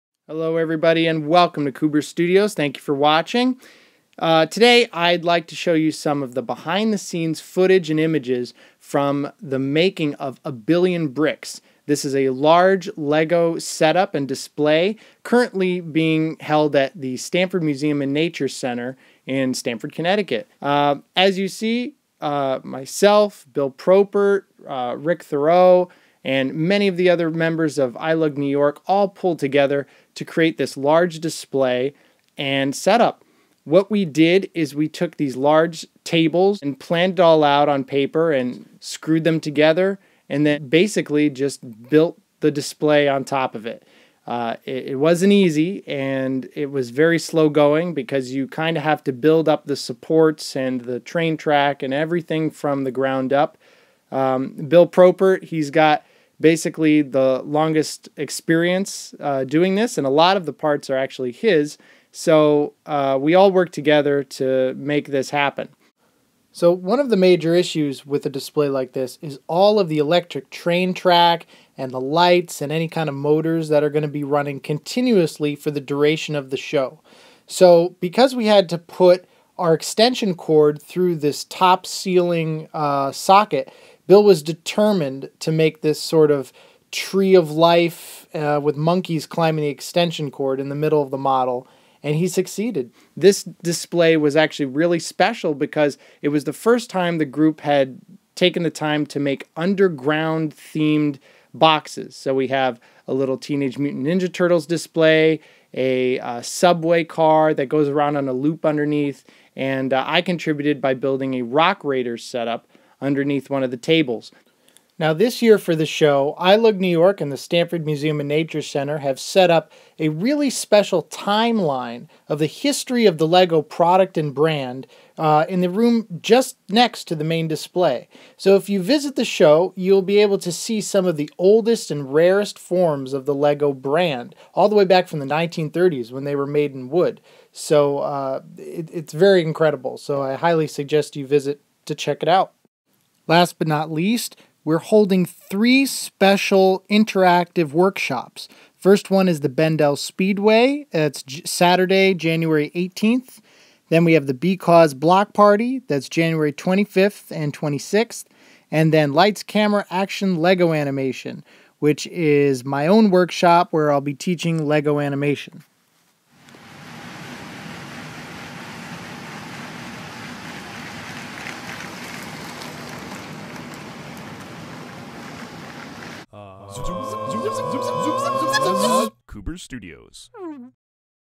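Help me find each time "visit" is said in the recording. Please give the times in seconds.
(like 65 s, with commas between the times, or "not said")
128 s, 141 s.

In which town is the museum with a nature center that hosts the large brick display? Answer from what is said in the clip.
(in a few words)
Stamford, Connecticut.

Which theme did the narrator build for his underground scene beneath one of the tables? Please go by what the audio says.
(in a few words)
Rock Raiders.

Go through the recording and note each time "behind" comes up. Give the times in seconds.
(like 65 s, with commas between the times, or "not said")
6 s.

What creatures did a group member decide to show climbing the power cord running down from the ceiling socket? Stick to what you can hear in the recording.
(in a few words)
monkeys.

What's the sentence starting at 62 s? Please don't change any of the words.
So uh, we all work together to make this happen.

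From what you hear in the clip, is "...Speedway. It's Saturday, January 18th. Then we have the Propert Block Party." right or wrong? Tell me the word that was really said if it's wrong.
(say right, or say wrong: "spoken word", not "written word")
wrong: "Because", not "Propert".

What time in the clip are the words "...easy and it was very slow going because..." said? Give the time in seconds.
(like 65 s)
45 s.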